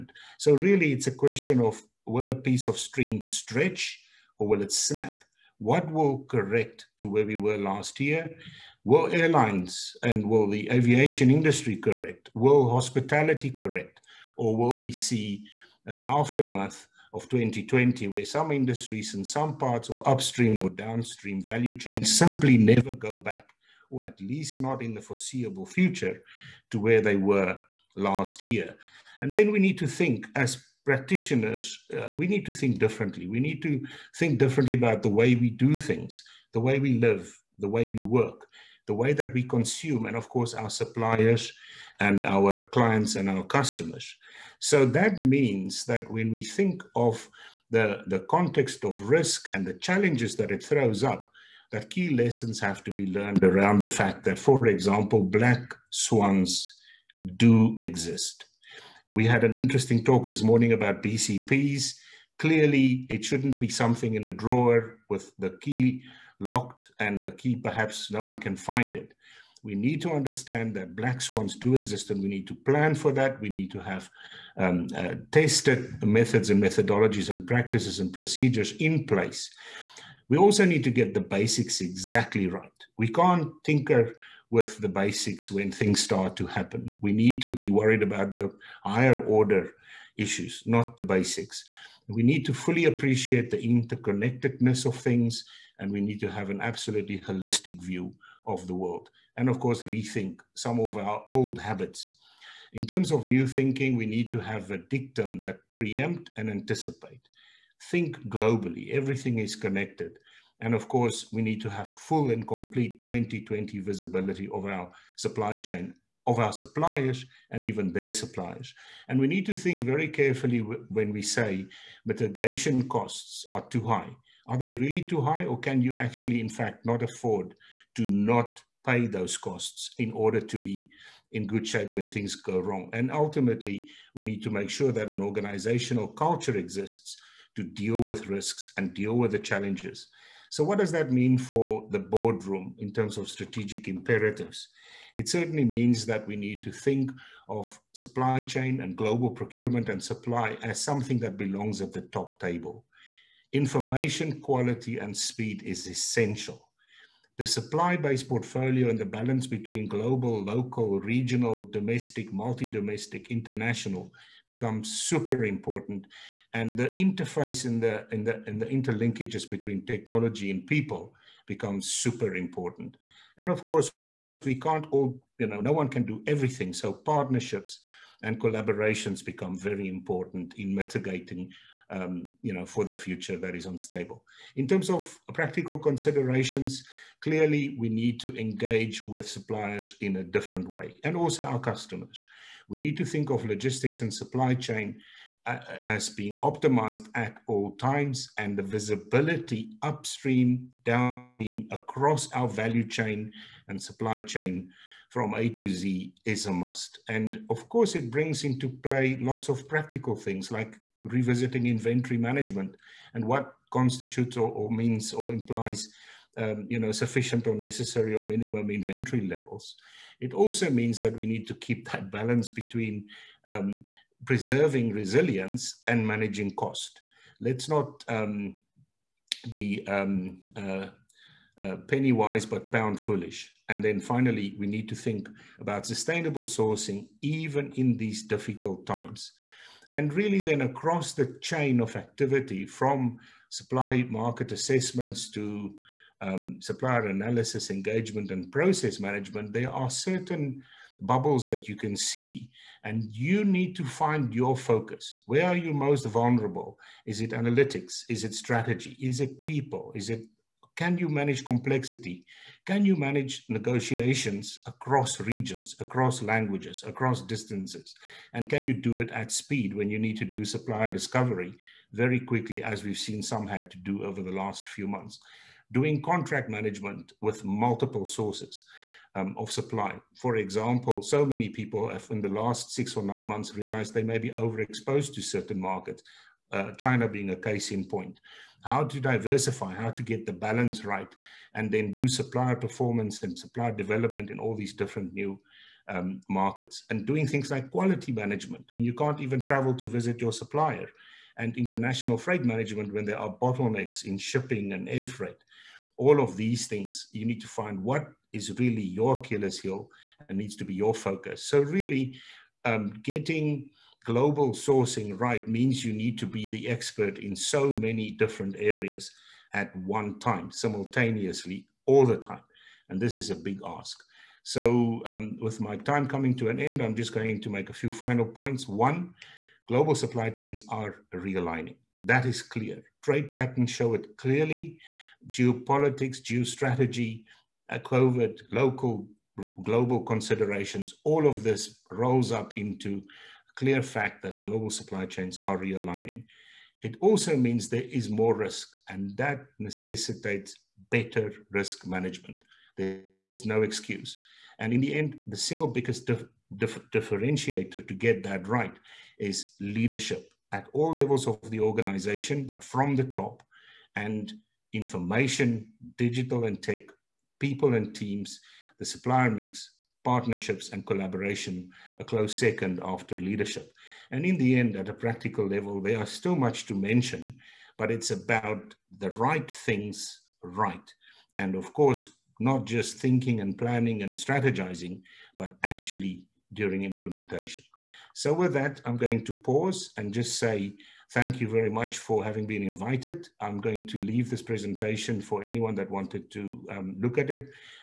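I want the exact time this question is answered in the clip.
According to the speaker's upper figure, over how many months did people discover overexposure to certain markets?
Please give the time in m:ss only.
4:43.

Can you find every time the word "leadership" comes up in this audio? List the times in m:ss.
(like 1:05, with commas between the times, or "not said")
5:59, 6:13.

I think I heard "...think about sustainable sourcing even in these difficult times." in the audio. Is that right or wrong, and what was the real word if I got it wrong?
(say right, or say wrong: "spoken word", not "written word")
right.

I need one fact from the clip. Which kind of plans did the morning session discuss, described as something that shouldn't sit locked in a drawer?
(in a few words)
BCPs.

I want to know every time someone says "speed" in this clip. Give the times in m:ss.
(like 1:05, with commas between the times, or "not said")
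2:35, 4:29.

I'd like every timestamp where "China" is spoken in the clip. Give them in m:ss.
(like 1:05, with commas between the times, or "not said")
4:46.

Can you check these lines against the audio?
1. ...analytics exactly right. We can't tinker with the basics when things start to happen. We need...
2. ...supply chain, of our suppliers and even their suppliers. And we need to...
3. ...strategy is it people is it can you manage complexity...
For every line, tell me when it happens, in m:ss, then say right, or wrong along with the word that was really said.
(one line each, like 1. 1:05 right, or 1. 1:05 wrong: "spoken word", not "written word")
1. 1:21 wrong: "basics", not "analytics"
2. 1:55 right
3. 4:18 right.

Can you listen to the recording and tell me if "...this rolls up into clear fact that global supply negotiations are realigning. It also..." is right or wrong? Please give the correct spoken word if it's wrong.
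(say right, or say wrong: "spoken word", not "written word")
wrong: "chains", not "negotiations".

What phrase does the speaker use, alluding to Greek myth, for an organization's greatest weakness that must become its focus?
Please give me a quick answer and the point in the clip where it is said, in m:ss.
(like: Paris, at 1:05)
Achilles heel, at 5:09.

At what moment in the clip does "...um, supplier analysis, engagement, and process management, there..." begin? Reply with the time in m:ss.
4:06.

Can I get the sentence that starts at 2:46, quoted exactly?
And the interface and the, the, the interlinkages between technology and people becomes super important.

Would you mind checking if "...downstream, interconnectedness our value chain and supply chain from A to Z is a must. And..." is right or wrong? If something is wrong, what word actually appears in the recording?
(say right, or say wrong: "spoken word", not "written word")
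wrong: "across", not "interconnectedness".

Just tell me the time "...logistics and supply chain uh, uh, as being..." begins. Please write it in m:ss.
3:13.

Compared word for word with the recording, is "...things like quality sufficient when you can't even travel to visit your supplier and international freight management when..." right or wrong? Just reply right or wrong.
wrong.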